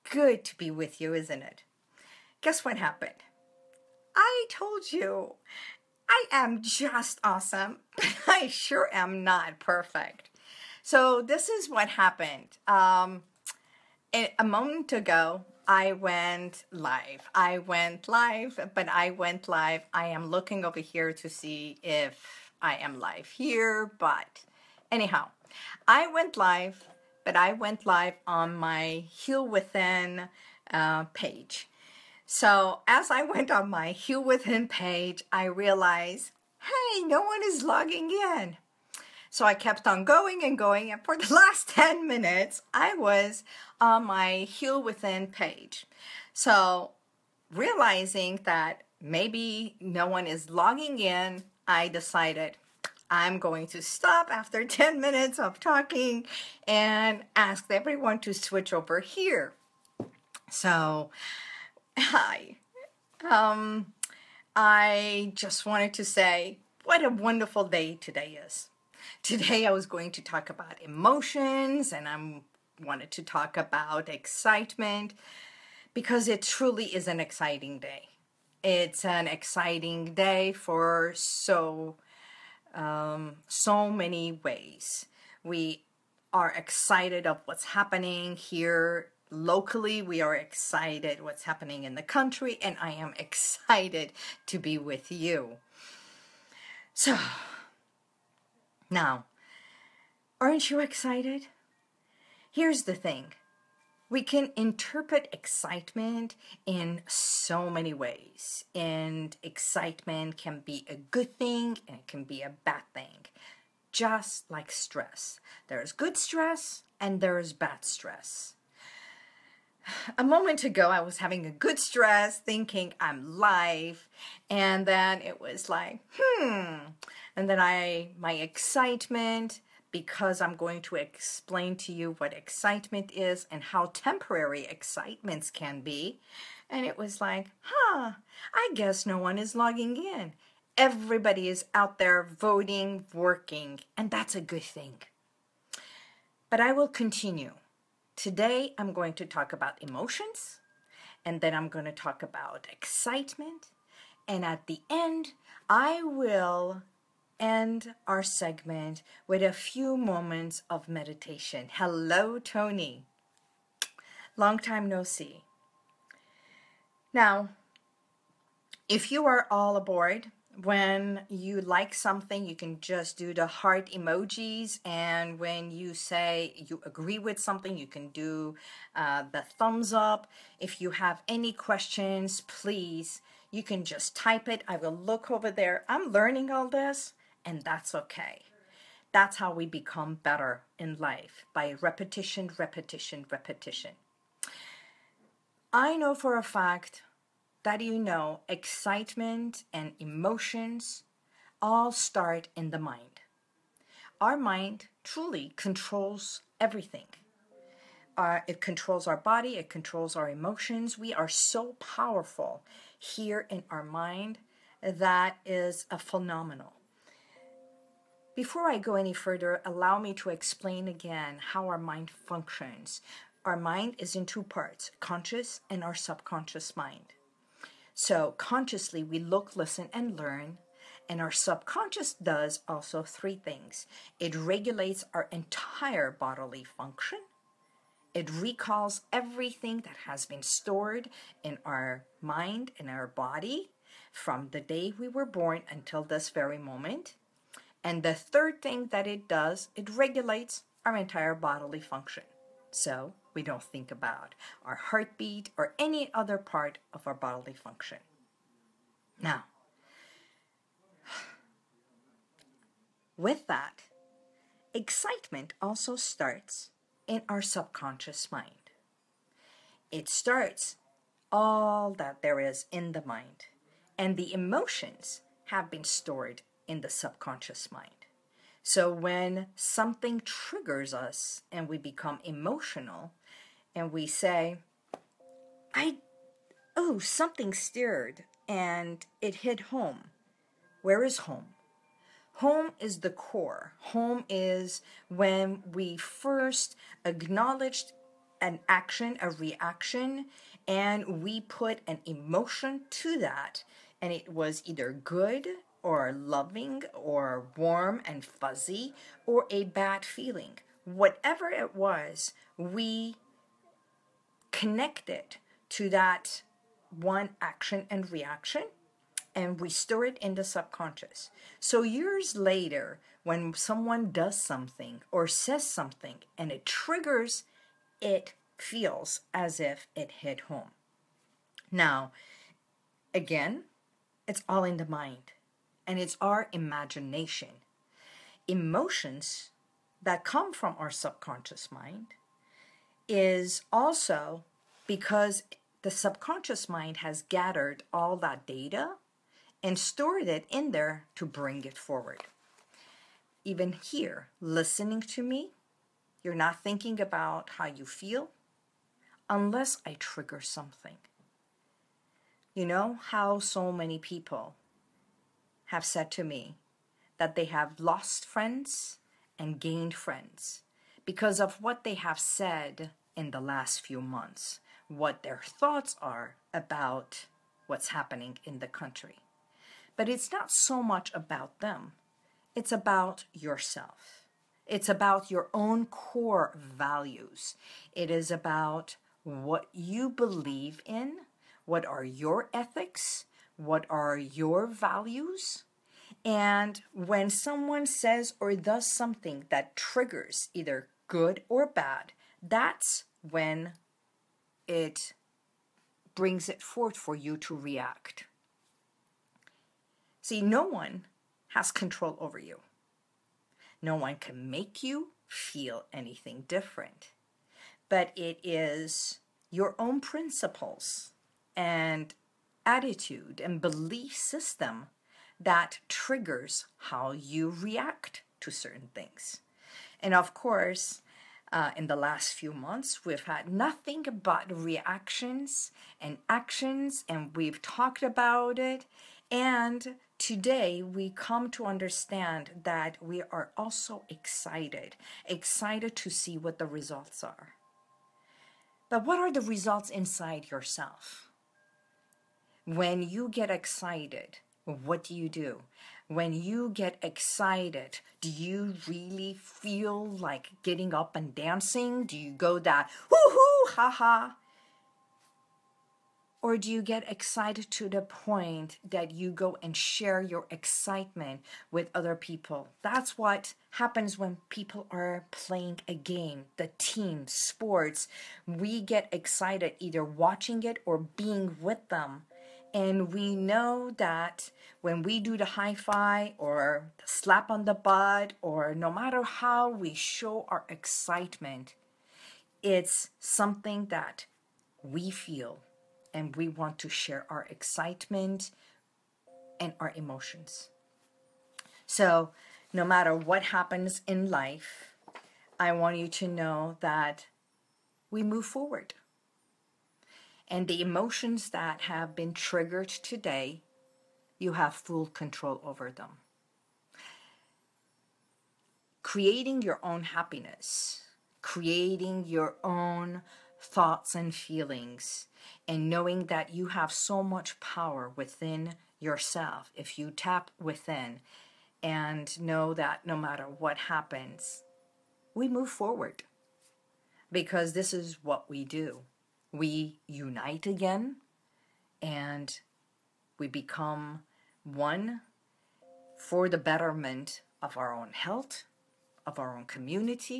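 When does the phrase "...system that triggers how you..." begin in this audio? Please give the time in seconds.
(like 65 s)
424 s.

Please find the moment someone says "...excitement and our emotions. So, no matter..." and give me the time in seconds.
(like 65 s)
497 s.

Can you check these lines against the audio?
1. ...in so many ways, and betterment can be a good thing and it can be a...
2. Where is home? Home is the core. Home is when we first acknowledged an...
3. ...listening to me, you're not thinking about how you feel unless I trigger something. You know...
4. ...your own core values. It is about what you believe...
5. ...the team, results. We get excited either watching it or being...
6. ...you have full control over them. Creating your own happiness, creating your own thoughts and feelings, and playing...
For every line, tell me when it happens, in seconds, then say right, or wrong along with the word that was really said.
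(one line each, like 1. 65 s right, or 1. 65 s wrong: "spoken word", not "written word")
1. 106 s wrong: "excitement", not "betterment"
2. 290 s right
3. 354 s right
4. 385 s right
5. 476 s wrong: "sports", not "results"
6. 514 s wrong: "knowing", not "playing".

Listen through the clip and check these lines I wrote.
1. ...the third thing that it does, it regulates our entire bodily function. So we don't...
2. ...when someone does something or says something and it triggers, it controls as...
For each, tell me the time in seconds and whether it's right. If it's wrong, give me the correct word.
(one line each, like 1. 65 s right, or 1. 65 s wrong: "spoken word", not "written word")
1. 248 s right
2. 323 s wrong: "feels", not "controls".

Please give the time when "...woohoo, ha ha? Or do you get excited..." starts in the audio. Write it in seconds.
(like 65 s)
463 s.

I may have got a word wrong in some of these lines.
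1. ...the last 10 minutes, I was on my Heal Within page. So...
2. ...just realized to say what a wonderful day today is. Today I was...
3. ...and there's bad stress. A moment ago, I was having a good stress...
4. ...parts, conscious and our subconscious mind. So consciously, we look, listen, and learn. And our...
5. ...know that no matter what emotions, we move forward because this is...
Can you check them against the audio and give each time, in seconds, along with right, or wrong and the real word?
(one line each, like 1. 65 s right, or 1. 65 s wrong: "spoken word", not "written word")
1. 41 s right
2. 65 s wrong: "wanted", not "realized"
3. 116 s right
4. 224 s right
5. 532 s wrong: "happens", not "emotions".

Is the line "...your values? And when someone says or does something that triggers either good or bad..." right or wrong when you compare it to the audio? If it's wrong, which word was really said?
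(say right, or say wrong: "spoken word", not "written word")
right.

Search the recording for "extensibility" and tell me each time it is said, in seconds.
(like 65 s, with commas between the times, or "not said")
not said.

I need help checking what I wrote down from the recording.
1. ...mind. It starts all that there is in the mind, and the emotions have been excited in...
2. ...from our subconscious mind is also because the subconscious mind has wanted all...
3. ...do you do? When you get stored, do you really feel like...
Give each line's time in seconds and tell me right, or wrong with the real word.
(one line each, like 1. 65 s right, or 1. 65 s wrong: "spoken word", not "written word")
1. 268 s wrong: "stored", not "excited"
2. 340 s wrong: "gathered", not "wanted"
3. 455 s wrong: "excited", not "stored".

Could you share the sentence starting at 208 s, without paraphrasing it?
Uh, it controls our body, it controls our emotions.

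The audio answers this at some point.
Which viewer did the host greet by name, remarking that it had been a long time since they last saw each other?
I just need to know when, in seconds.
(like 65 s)
162 s.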